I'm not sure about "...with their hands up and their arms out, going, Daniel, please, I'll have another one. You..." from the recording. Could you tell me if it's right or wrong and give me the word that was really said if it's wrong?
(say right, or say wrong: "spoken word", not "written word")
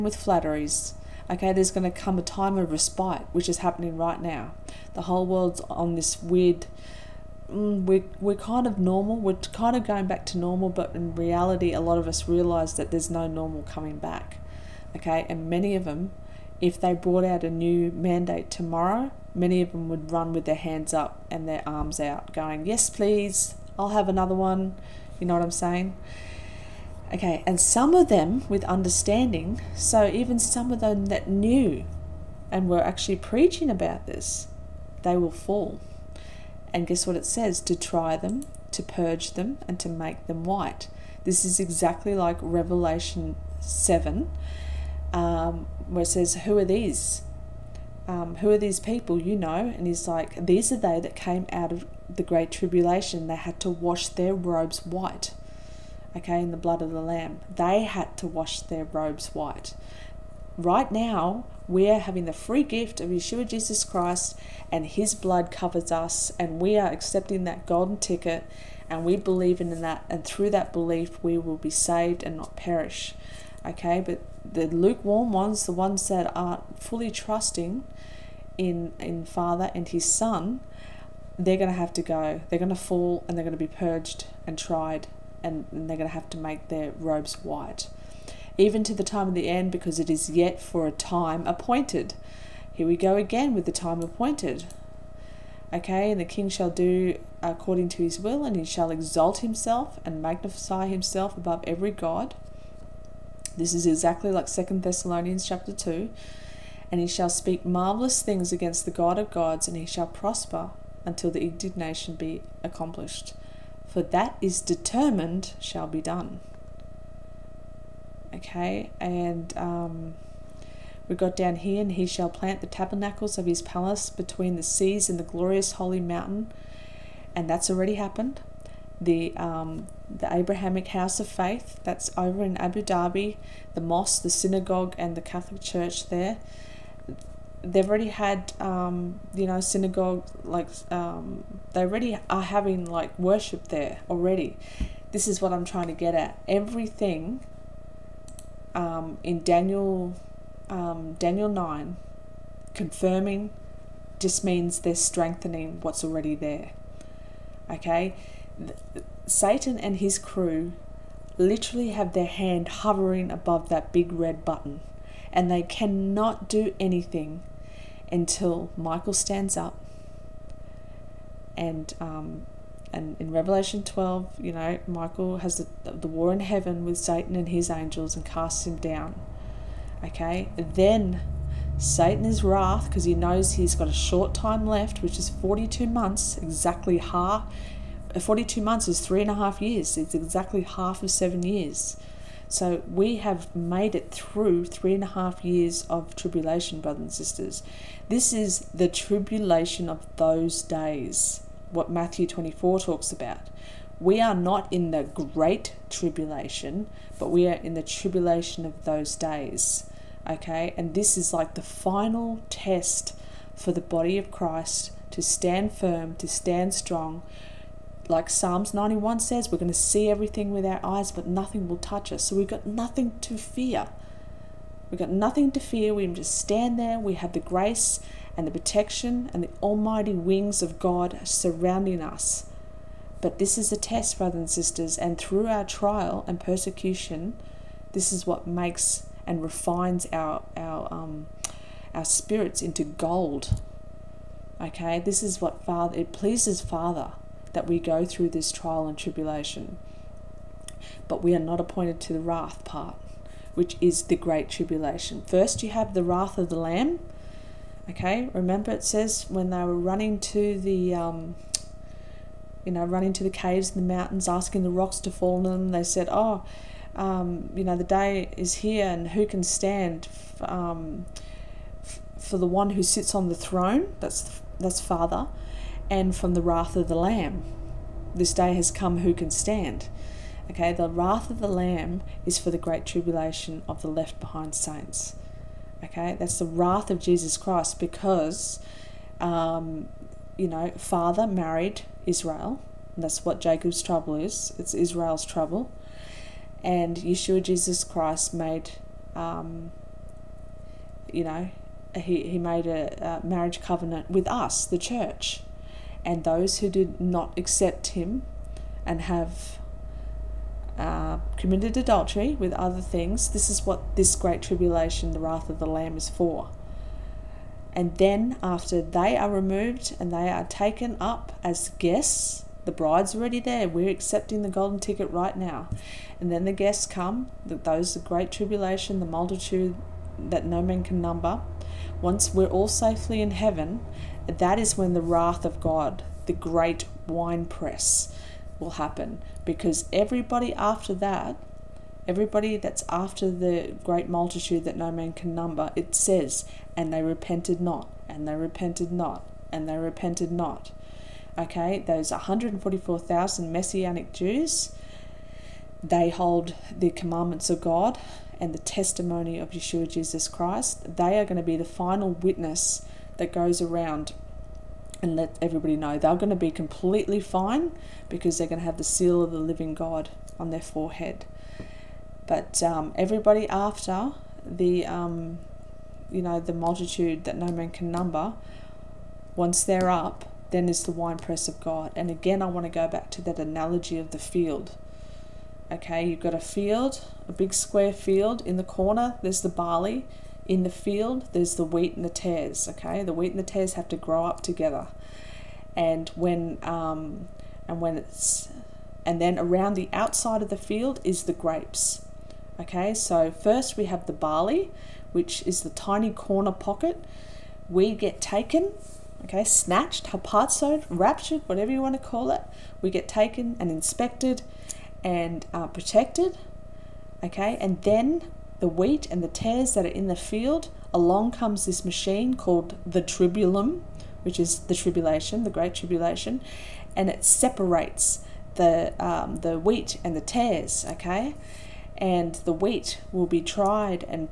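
wrong: "Yes", not "Daniel".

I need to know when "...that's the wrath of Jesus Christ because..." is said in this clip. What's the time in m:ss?
4:46.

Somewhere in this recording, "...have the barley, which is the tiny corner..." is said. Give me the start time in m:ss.
6:43.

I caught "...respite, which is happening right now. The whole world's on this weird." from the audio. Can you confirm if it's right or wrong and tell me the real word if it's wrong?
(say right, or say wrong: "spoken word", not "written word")
right.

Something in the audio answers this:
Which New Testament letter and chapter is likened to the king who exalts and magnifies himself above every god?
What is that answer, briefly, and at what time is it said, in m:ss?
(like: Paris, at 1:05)
Second Thessalonians chapter 2, at 1:44.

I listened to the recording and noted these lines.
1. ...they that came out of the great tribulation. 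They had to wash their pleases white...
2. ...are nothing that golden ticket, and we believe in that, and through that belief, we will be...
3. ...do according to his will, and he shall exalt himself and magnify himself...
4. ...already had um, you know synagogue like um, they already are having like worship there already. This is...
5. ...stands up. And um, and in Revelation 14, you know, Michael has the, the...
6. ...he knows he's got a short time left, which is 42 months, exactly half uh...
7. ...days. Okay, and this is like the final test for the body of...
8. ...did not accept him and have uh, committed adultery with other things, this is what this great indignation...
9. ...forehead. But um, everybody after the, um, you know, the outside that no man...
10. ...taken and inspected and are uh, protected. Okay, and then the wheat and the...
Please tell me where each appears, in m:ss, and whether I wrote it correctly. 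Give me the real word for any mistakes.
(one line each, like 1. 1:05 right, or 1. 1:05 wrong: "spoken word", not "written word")
1. 0:50 wrong: "robes", not "pleases"
2. 1:06 wrong: "accepting", not "nothing"
3. 1:36 right
4. 2:17 right
5. 2:49 wrong: "12", not "14"
6. 3:03 right
7. 3:29 right
8. 5:06 wrong: "tribulation", not "indignation"
9. 6:10 wrong: "multitude", not "outside"
10. 6:53 right.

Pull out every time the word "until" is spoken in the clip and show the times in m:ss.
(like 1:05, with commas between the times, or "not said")
1:51, 2:48.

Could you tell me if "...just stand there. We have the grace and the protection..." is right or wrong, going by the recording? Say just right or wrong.
right.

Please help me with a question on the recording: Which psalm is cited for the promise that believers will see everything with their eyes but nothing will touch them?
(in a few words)
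Psalms 91.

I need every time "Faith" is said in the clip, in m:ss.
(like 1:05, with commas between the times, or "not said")
2:11.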